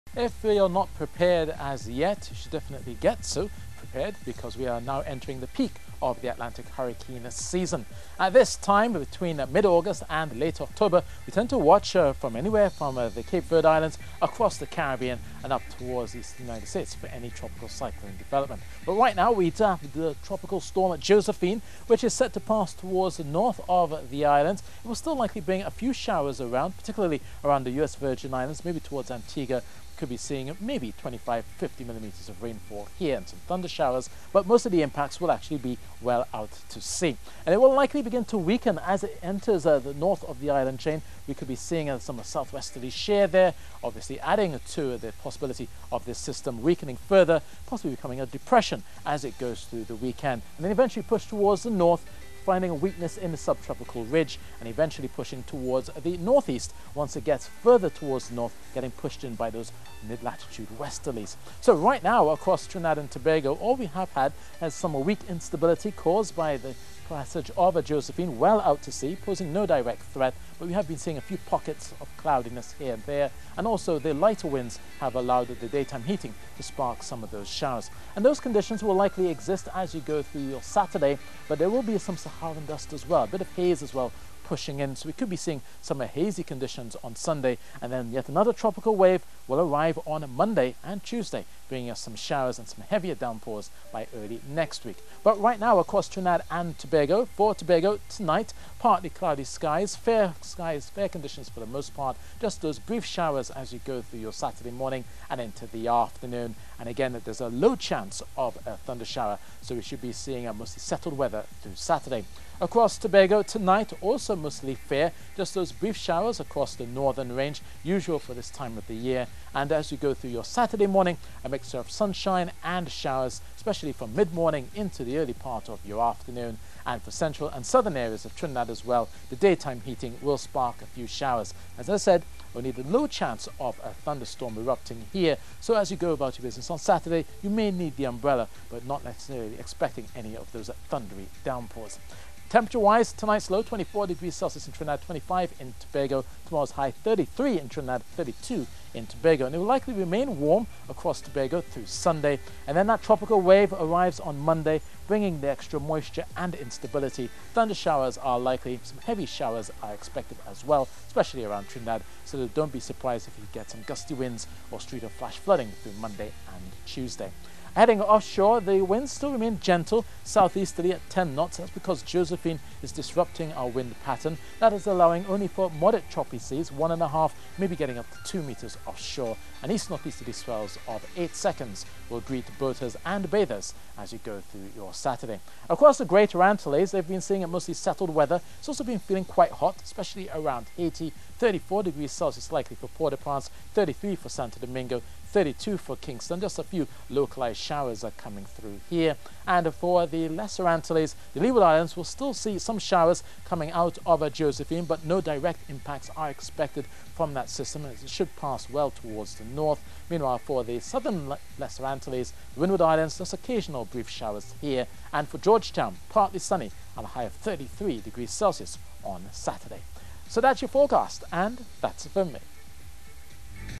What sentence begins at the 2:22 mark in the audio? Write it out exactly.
Temperature-wise, tonight's low 24 degrees Celsius in Trinidad, 25 in Tobago.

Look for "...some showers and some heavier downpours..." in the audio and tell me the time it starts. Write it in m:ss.
1:32.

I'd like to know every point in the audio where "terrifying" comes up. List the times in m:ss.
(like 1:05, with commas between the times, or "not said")
not said.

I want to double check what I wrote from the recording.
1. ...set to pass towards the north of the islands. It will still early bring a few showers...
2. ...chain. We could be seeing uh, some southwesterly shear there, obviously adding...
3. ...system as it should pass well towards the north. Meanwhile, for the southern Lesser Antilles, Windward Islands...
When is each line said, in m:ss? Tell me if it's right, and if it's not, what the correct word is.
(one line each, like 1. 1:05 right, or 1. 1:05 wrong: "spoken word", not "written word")
1. 0:22 wrong: "likely", not "early"
2. 0:40 right
3. 3:27 right.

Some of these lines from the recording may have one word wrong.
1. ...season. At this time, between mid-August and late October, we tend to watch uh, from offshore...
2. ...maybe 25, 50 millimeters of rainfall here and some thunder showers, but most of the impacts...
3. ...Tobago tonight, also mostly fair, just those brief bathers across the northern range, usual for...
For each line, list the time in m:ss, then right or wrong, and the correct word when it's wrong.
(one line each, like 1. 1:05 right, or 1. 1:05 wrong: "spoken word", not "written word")
1. 0:07 wrong: "anywhere", not "offshore"
2. 0:30 right
3. 1:52 wrong: "showers", not "bathers".